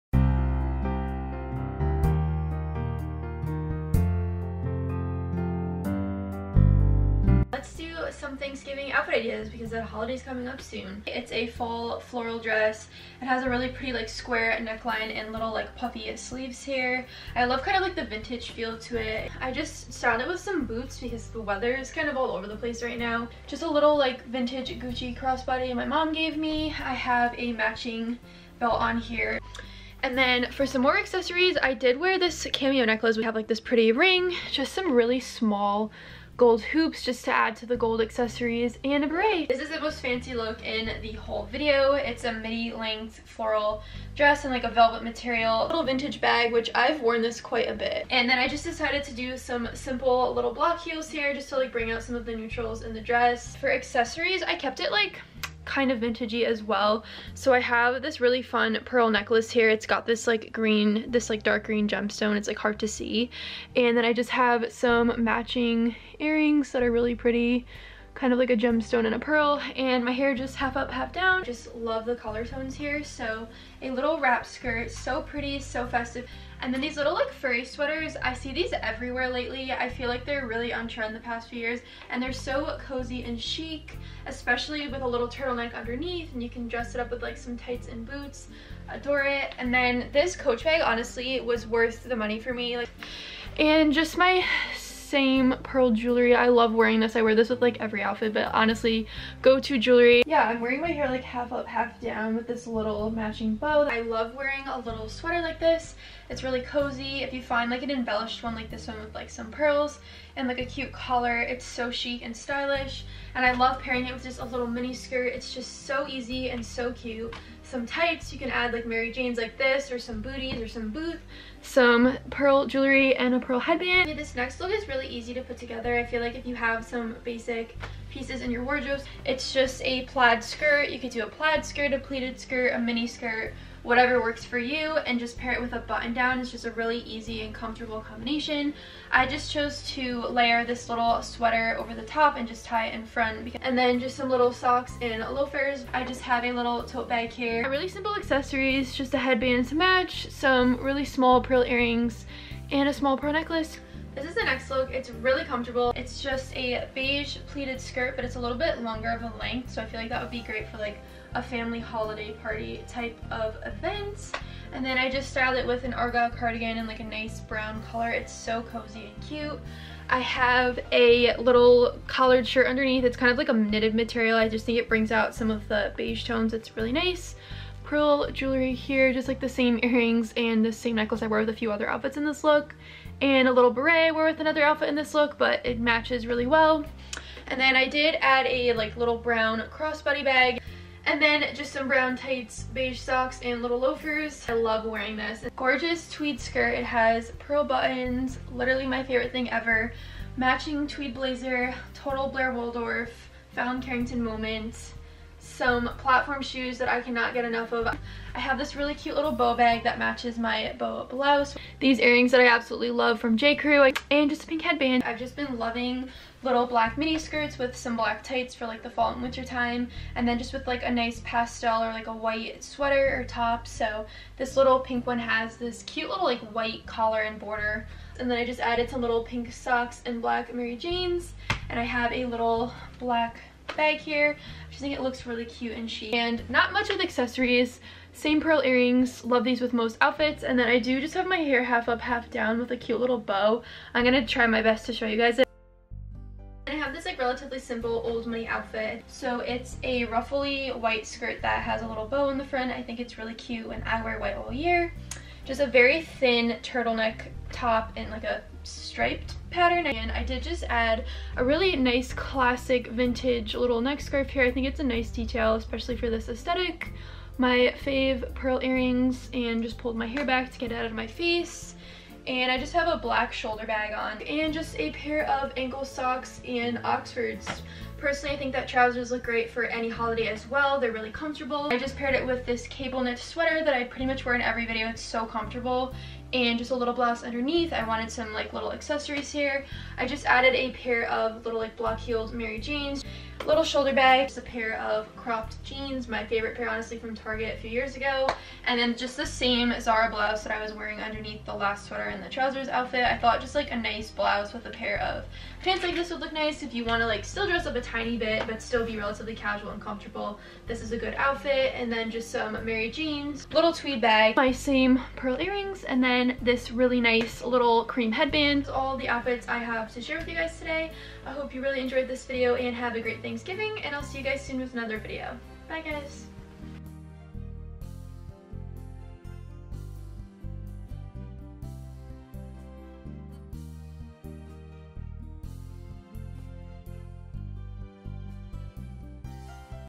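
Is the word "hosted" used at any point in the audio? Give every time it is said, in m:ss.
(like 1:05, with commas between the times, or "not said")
not said.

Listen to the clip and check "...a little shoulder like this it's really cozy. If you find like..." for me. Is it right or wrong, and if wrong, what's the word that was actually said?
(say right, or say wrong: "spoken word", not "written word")
wrong: "sweater", not "shoulder".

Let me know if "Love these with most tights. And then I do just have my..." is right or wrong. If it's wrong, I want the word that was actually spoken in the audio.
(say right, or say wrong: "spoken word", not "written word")
wrong: "outfits", not "tights".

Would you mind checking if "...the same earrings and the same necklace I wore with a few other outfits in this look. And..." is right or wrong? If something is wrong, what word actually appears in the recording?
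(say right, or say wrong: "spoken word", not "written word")
right.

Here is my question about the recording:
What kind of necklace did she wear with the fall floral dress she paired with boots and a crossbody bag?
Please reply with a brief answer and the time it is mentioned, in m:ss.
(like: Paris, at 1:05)
Cameo necklace, at 0:32.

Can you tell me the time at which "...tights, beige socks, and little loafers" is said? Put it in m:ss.
3:12.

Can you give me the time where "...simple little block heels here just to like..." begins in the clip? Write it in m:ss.
0:49.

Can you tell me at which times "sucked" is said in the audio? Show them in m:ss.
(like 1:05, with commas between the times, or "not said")
not said.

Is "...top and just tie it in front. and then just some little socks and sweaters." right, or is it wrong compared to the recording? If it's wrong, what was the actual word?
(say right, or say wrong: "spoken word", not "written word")
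wrong: "loafers", not "sweaters".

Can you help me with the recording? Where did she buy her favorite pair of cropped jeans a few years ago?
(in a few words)
Target.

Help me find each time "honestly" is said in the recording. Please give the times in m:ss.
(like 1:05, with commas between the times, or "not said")
1:30, 1:38, 4:56.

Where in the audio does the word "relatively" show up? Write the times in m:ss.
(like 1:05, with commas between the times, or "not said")
4:07, 5:08.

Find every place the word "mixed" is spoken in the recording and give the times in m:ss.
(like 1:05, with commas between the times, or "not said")
not said.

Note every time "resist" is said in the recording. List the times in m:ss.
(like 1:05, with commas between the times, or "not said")
not said.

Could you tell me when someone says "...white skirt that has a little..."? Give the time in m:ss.
4:10.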